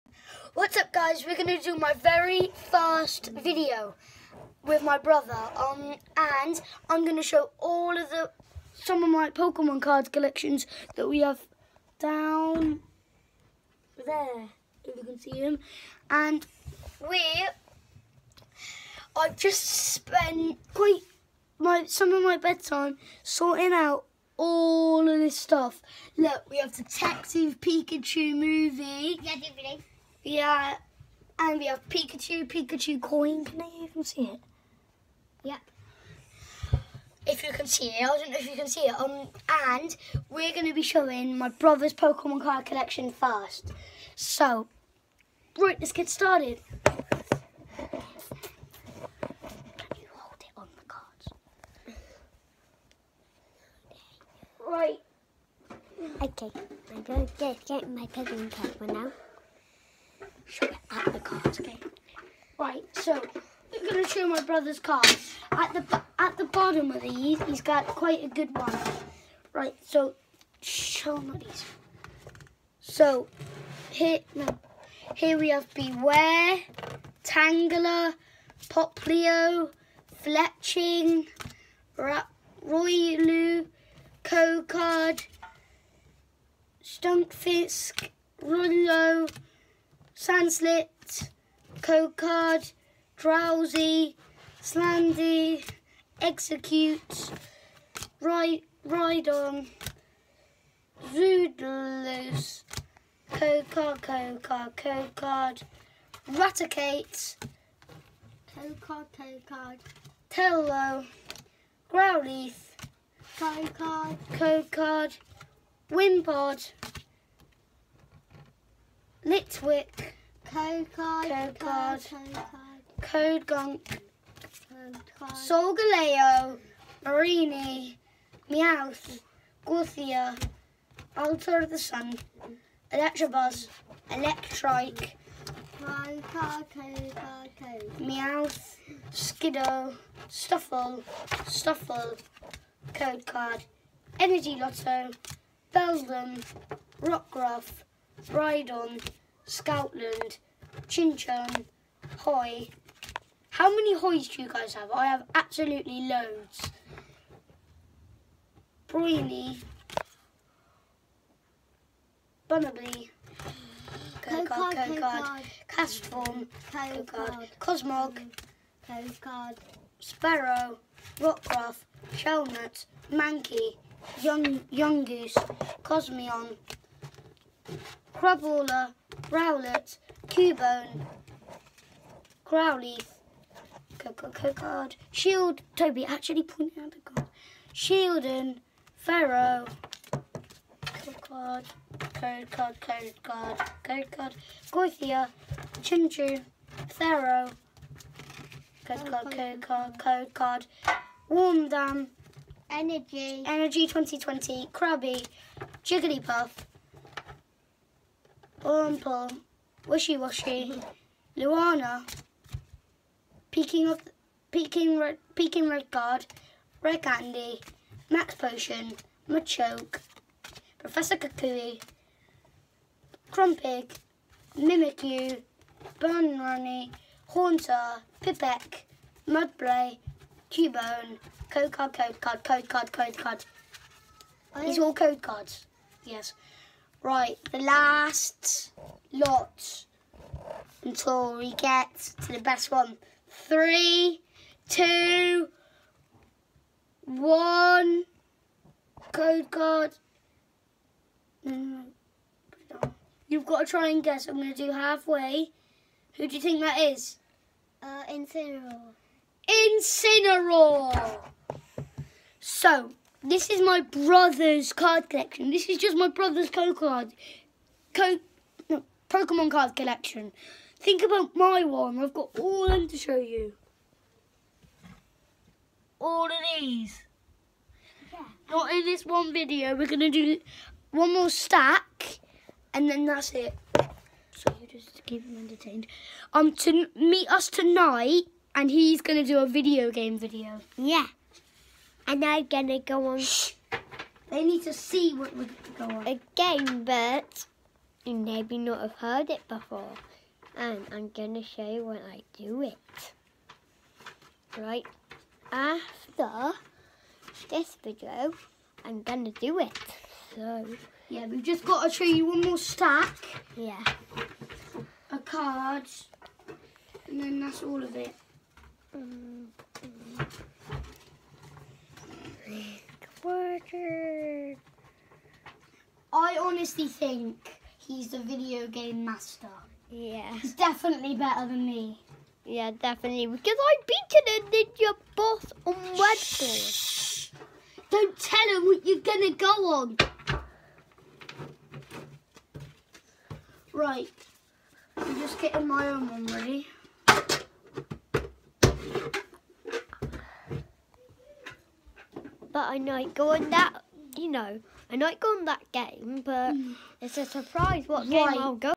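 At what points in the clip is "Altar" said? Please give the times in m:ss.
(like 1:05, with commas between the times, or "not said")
2:11.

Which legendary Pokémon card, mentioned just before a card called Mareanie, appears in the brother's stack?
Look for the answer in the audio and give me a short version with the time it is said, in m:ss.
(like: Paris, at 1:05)
Solgaleo, at 2:05.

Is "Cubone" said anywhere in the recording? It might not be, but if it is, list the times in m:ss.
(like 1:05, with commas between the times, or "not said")
3:00, 3:50.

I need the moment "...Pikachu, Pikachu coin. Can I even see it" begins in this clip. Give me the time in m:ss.
0:31.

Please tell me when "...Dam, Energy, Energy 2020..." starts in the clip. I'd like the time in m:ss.
3:21.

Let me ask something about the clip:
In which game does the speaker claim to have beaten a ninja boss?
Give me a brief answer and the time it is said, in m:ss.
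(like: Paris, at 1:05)
Redball, at 5:35.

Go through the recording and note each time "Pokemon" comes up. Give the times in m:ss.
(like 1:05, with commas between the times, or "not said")
0:09, 0:41, 0:58, 4:29.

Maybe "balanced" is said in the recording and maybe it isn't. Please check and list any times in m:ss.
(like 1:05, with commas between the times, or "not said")
not said.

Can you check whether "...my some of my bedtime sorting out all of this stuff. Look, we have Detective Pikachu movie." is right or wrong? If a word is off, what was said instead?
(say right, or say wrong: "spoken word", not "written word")
right.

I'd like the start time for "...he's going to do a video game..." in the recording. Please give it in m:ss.
4:48.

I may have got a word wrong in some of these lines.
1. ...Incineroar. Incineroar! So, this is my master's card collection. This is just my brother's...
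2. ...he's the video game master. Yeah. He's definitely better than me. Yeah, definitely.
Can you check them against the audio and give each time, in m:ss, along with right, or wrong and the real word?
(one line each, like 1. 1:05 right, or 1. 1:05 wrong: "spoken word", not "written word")
1. 4:18 wrong: "brother", not "master"
2. 5:27 right.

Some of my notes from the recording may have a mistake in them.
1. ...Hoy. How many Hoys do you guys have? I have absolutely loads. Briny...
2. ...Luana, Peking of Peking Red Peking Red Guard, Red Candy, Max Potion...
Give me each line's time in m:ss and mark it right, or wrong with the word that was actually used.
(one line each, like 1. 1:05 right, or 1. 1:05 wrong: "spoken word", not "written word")
1. 2:32 right
2. 3:31 right.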